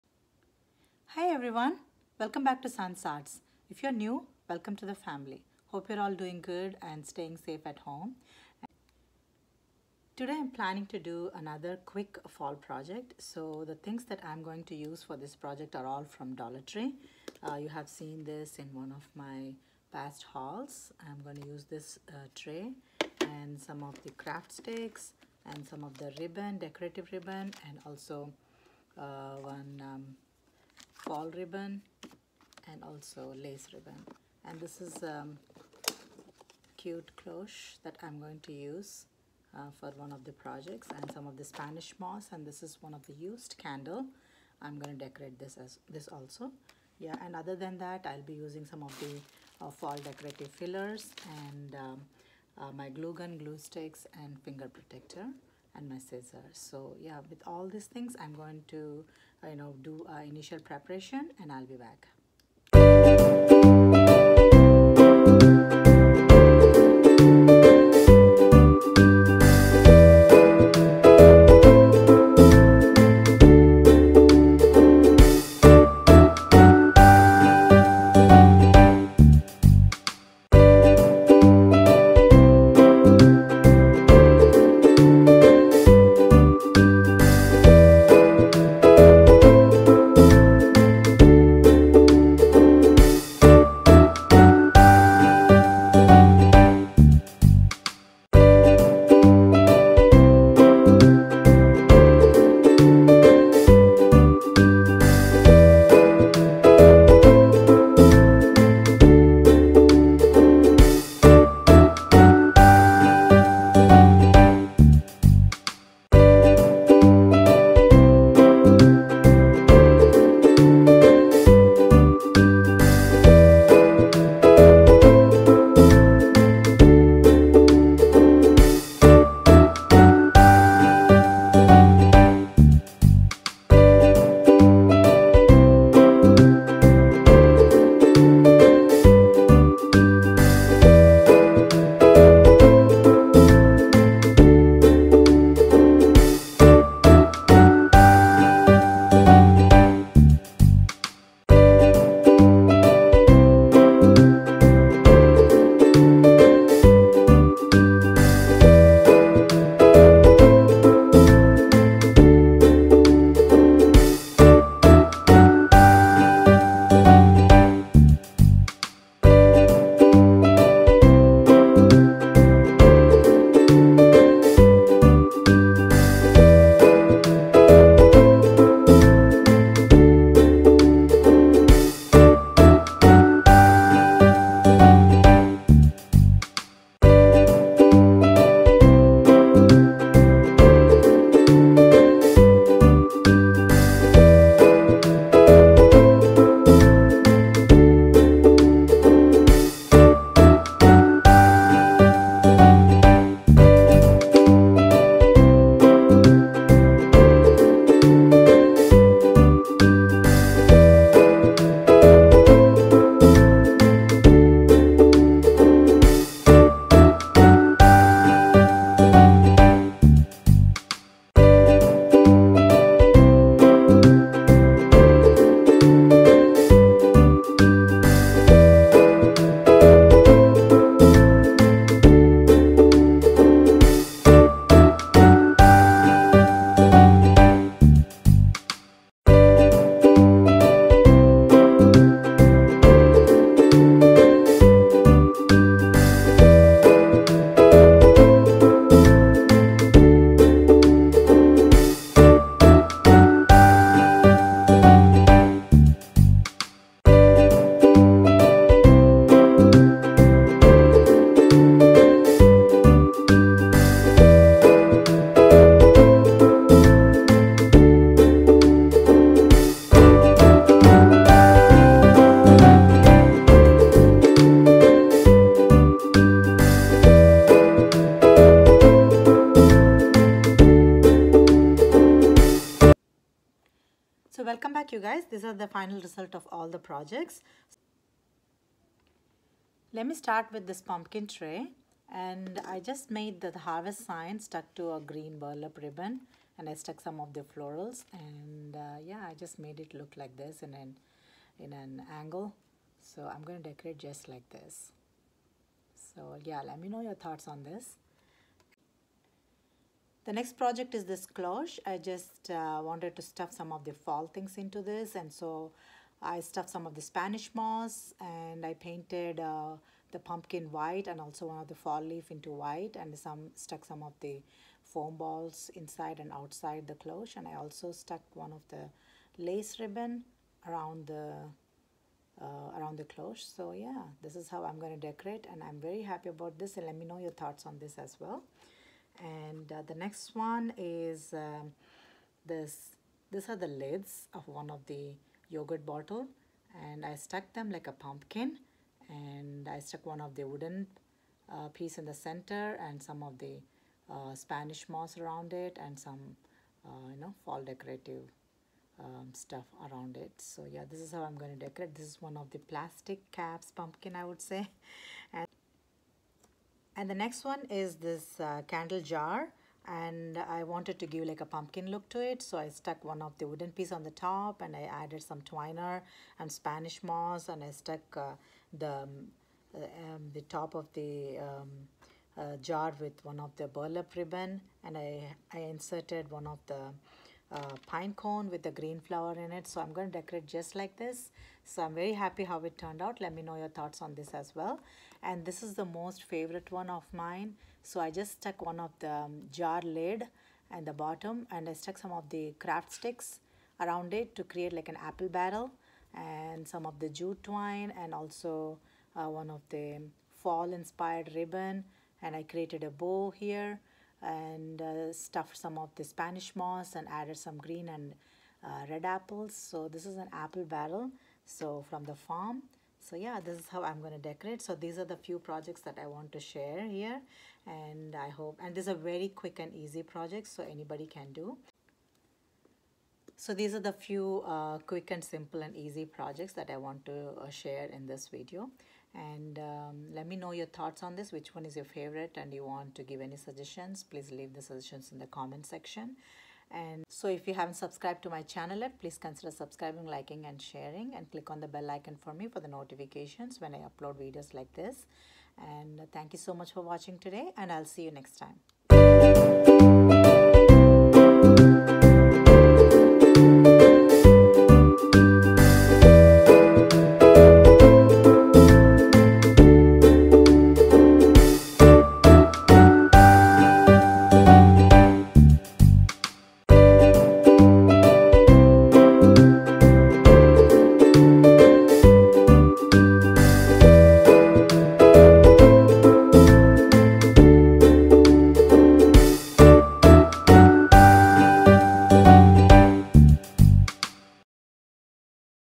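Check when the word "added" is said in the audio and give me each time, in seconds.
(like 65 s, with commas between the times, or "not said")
375 s, 417 s.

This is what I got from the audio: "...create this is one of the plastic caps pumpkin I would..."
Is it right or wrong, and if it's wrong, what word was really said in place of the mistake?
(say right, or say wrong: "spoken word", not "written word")
wrong: "decorate", not "create".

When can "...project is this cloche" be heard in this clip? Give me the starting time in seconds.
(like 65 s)
310 s.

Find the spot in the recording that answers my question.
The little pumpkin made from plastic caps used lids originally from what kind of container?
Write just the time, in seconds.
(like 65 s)
345 s.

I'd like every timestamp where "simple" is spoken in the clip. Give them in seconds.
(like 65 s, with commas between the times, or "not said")
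435 s.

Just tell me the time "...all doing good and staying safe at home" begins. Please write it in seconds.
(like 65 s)
5 s.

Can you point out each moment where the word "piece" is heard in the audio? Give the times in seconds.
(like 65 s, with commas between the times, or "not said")
351 s, 373 s.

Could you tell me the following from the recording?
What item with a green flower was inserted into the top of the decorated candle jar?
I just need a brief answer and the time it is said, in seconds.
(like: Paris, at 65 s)
Pine cone, at 387 s.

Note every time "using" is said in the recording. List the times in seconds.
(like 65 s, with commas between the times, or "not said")
48 s.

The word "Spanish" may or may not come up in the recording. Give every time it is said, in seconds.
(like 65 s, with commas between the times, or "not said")
41 s, 317 s, 354 s, 376 s, 416 s.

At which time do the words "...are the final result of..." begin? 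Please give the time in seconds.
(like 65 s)
285 s.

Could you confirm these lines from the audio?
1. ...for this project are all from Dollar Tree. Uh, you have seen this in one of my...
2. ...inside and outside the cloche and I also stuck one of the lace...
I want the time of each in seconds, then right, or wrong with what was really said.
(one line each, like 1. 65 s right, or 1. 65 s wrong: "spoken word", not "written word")
1. 15 s right
2. 325 s right.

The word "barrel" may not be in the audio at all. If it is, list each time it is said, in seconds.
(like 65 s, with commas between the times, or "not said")
405 s, 420 s.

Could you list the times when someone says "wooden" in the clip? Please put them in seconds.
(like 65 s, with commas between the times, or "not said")
350 s, 373 s.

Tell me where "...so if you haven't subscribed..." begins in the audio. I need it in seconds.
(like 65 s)
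447 s.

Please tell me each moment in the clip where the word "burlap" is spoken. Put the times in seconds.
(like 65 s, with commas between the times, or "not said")
295 s, 383 s.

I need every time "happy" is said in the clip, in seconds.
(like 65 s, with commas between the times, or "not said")
336 s, 392 s.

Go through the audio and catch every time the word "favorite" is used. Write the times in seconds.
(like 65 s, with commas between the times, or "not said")
396 s, 441 s.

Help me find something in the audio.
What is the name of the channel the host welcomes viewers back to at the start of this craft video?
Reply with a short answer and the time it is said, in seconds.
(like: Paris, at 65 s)
Sun's Arts, at 2 s.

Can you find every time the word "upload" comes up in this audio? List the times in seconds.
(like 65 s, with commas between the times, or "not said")
453 s.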